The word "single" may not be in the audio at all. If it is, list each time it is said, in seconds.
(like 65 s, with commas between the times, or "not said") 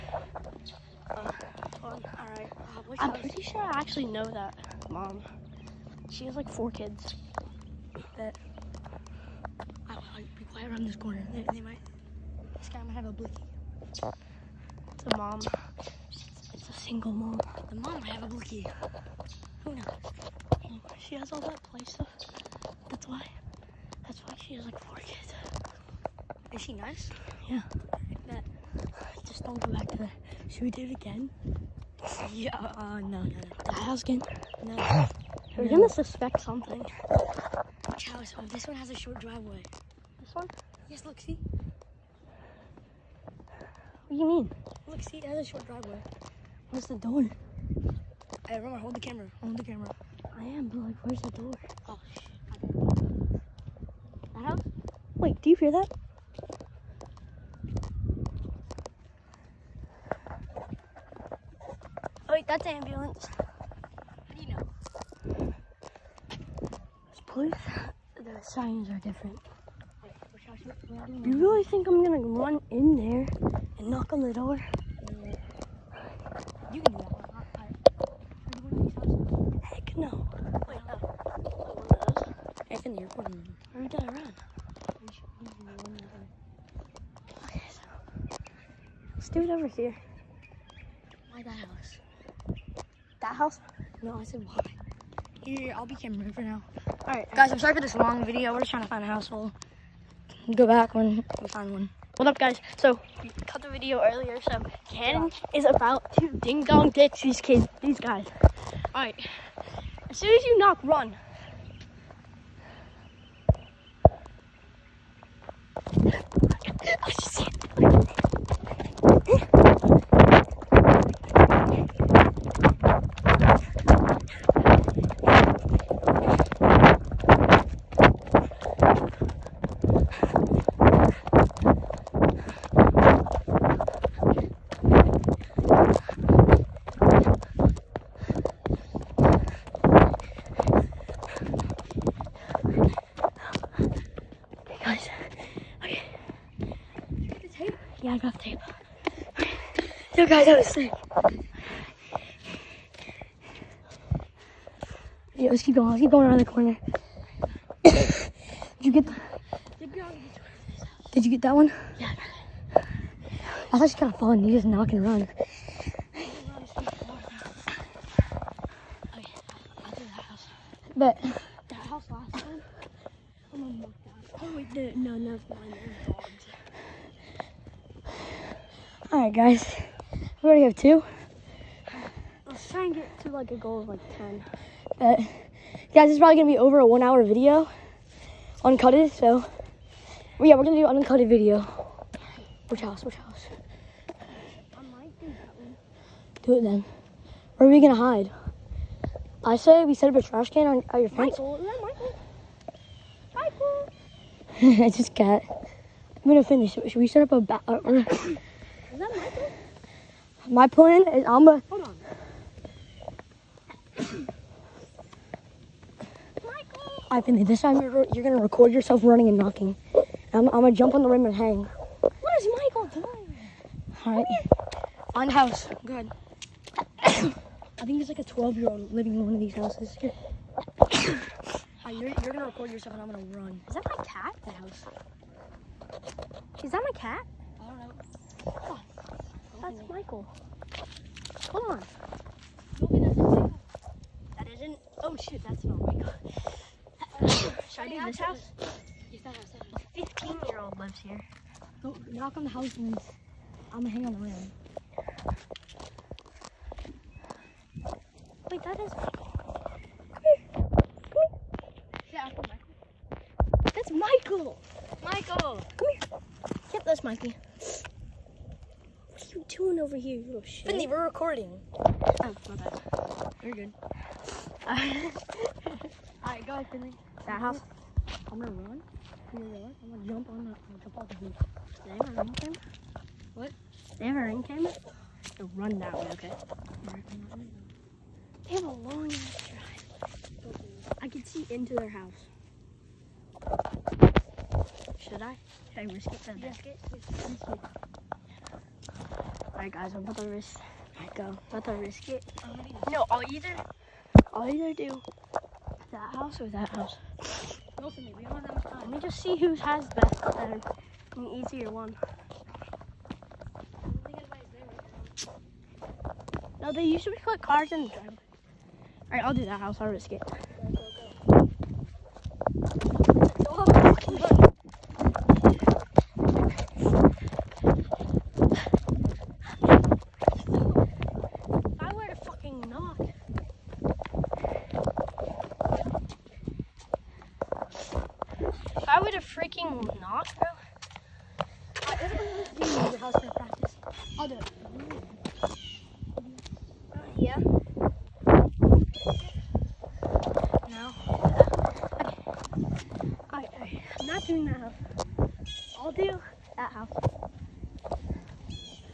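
16 s.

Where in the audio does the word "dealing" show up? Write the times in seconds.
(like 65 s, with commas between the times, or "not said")
not said.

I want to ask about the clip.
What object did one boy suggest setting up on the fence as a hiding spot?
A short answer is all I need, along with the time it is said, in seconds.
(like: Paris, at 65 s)
trash can, at 200 s.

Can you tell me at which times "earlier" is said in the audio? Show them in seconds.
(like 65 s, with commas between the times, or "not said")
104 s.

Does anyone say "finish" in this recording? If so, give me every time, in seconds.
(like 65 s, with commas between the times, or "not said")
206 s.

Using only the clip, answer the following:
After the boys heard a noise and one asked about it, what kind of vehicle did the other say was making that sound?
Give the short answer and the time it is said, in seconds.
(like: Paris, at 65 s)
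ambulance, at 62 s.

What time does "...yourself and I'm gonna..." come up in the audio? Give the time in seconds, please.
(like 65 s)
232 s.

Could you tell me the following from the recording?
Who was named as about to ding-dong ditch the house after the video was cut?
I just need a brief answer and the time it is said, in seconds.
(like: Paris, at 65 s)
Cannon, at 104 s.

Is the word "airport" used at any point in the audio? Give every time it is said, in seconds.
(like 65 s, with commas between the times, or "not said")
83 s.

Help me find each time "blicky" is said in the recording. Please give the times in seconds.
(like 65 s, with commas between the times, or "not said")
13 s, 18 s.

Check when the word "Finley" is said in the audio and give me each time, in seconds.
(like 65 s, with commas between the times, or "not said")
270 s, 276 s.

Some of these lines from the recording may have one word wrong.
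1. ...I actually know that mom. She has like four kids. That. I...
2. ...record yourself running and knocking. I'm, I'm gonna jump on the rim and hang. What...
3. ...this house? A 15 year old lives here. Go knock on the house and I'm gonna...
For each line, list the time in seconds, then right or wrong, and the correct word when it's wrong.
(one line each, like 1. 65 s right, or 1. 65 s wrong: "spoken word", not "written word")
1. 3 s right
2. 218 s right
3. 248 s right.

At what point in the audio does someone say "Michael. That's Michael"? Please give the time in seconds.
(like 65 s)
262 s.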